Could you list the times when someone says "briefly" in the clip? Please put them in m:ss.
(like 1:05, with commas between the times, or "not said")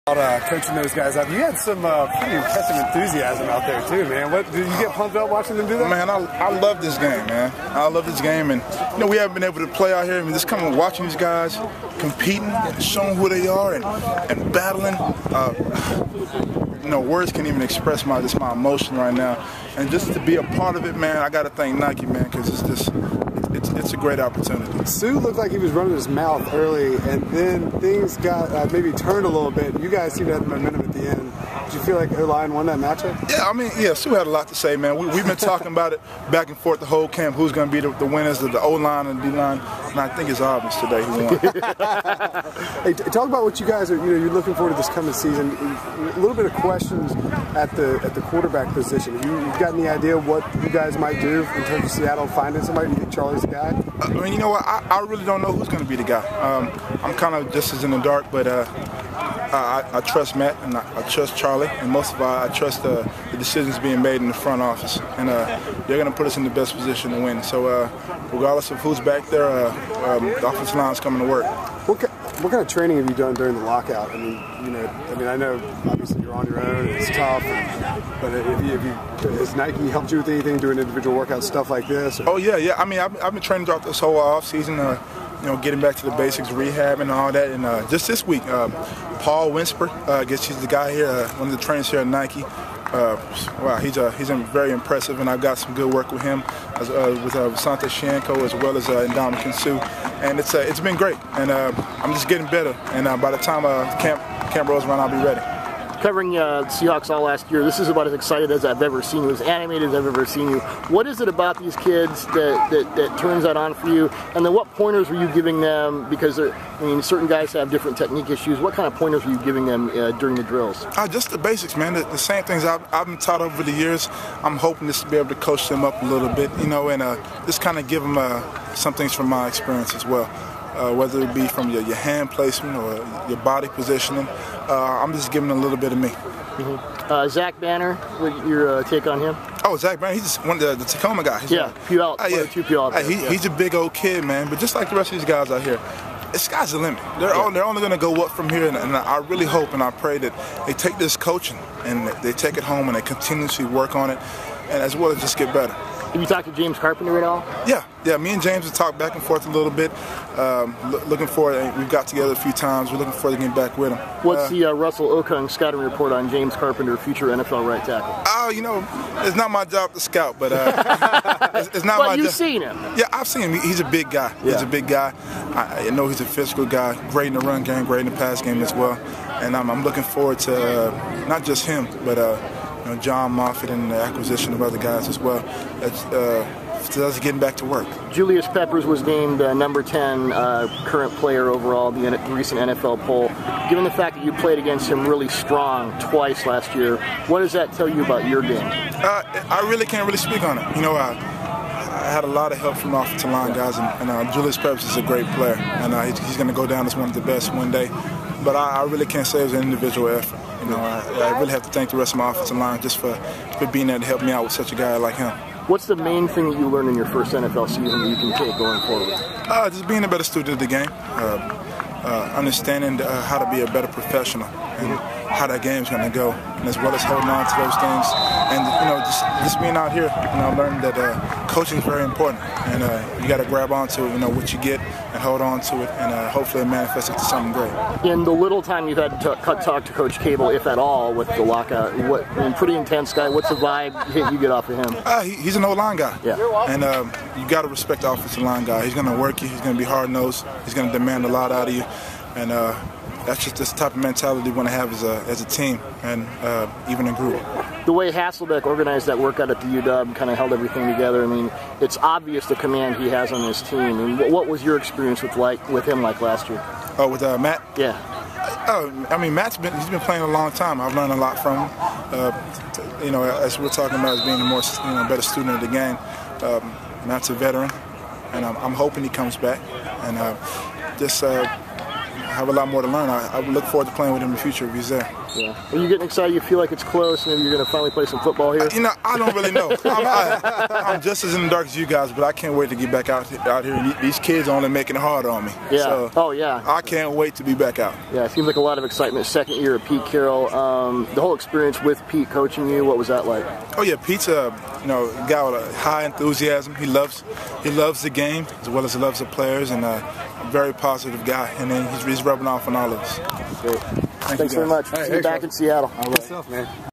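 not said.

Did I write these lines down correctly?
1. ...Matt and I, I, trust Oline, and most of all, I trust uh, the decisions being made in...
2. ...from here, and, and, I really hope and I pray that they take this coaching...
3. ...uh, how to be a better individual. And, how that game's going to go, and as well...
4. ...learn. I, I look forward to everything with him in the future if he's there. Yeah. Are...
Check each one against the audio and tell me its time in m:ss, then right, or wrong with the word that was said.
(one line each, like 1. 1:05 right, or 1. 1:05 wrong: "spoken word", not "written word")
1. 1:00 wrong: "Charlie", not "Oline"
2. 2:28 right
3. 3:42 wrong: "professional", not "individual"
4. 4:42 wrong: "playing", not "everything".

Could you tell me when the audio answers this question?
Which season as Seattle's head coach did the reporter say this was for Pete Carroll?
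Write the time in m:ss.
4:59.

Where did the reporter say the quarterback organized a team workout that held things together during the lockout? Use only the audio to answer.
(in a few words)
UW.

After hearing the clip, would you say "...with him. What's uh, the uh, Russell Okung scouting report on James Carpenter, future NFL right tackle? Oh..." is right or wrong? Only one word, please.
right.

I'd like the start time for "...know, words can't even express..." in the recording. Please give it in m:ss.
0:16.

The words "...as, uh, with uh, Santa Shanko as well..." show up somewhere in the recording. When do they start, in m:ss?
1:36.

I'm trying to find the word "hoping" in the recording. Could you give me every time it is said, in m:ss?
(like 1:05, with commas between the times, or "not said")
2:04, 4:38.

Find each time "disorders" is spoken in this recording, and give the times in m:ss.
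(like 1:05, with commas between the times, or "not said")
not said.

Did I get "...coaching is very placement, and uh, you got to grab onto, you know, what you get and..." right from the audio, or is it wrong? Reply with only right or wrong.
wrong.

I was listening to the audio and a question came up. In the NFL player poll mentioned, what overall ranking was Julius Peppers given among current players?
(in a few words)
10.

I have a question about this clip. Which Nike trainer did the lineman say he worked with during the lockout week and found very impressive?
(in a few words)
Paul Winsper.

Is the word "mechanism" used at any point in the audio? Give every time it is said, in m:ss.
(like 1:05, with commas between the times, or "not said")
not said.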